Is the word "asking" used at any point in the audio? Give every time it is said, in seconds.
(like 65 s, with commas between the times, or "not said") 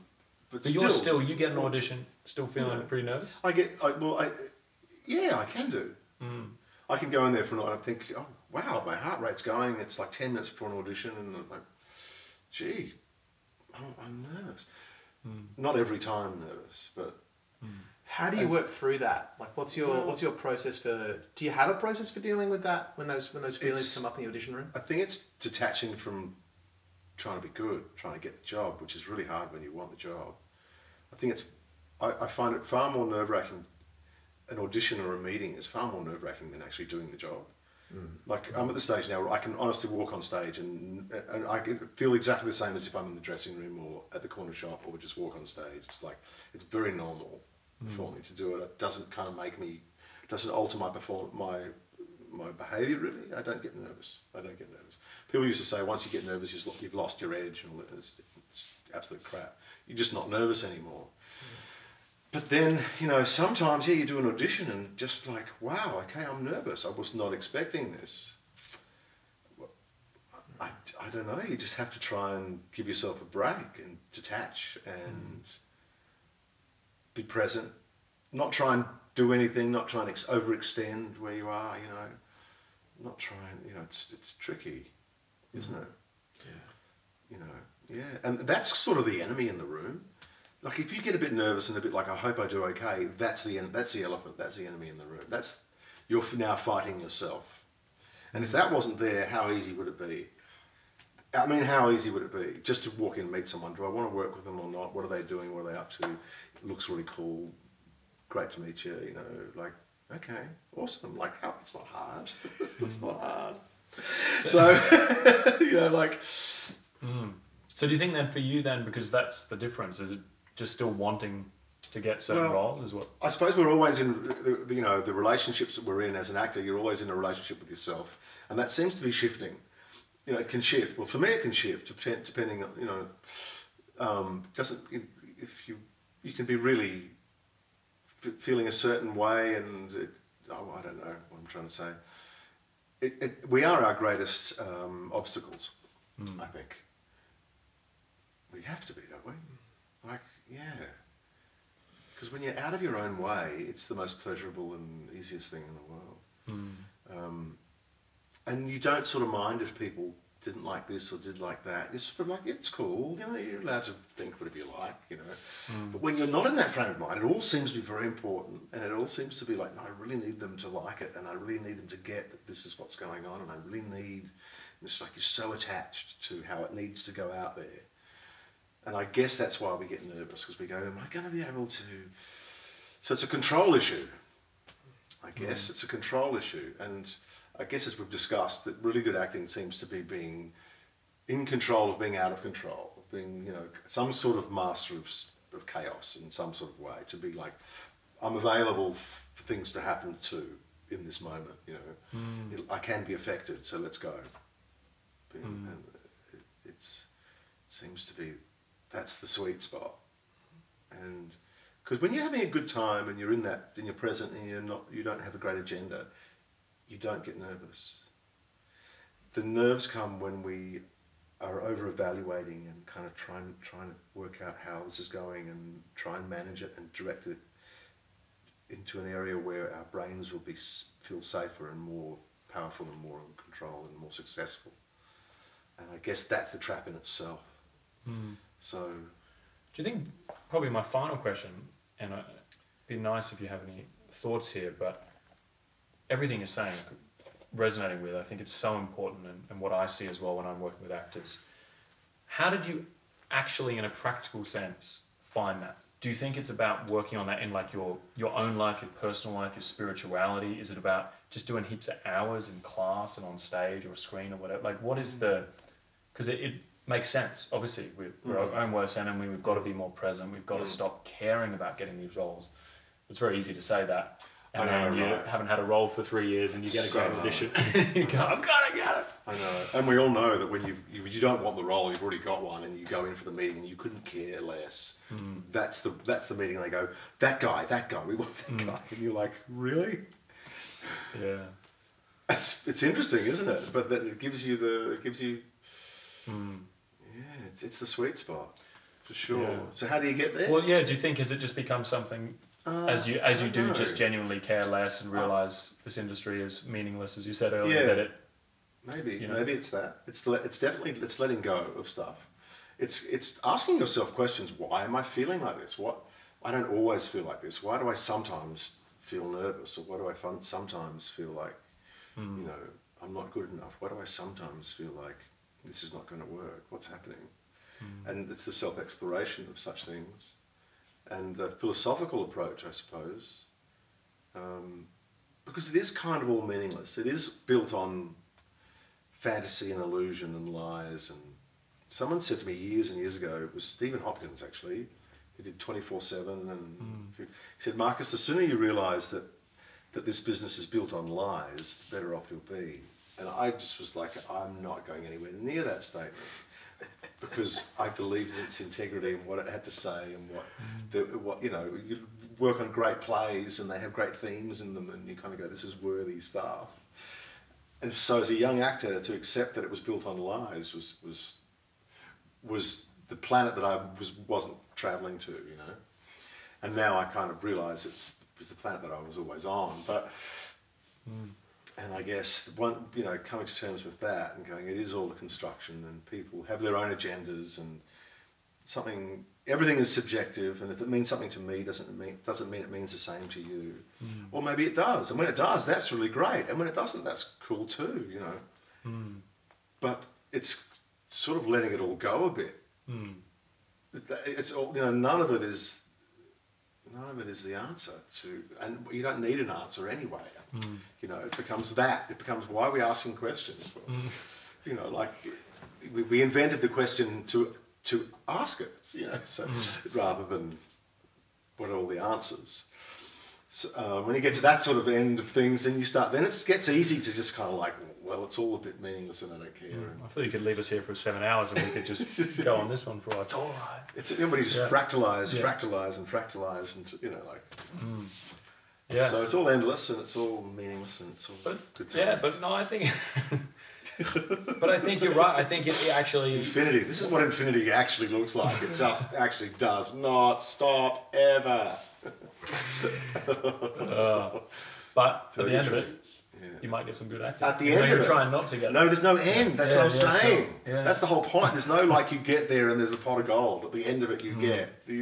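313 s, 412 s.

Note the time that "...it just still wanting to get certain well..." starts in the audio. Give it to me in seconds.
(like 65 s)
120 s.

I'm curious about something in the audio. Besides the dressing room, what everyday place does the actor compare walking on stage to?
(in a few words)
the corner shop.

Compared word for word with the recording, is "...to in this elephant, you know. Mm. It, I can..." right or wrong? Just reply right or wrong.
wrong.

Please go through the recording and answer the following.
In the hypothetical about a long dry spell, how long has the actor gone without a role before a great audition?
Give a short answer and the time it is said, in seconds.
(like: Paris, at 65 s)
3 years, at 276 s.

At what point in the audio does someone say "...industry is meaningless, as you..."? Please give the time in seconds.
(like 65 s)
305 s.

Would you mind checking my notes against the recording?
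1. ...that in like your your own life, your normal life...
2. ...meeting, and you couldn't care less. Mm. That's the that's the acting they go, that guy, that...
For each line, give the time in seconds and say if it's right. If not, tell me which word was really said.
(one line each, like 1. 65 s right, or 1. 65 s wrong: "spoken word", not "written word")
1. 257 s wrong: "personal", not "normal"
2. 283 s wrong: "meeting", not "acting".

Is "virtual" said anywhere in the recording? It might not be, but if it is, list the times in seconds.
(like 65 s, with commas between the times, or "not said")
not said.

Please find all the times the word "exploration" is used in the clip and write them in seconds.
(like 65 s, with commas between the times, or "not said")
328 s.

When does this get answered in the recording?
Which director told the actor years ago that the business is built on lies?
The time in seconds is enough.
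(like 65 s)
343 s.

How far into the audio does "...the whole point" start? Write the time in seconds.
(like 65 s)
460 s.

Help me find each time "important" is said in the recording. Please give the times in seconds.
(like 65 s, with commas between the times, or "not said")
168 s, 248 s.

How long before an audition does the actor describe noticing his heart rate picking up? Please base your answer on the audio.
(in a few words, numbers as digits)
10 minutes.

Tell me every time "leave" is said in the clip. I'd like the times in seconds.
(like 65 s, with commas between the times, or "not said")
430 s.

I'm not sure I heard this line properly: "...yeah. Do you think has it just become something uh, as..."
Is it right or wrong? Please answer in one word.
right.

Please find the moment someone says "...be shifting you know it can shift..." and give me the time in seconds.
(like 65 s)
129 s.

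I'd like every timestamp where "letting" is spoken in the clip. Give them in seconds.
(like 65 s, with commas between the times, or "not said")
311 s, 401 s.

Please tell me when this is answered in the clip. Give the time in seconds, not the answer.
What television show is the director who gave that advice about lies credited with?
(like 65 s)
345 s.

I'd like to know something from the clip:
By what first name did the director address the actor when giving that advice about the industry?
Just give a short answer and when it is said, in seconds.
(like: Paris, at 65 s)
Marcus, at 347 s.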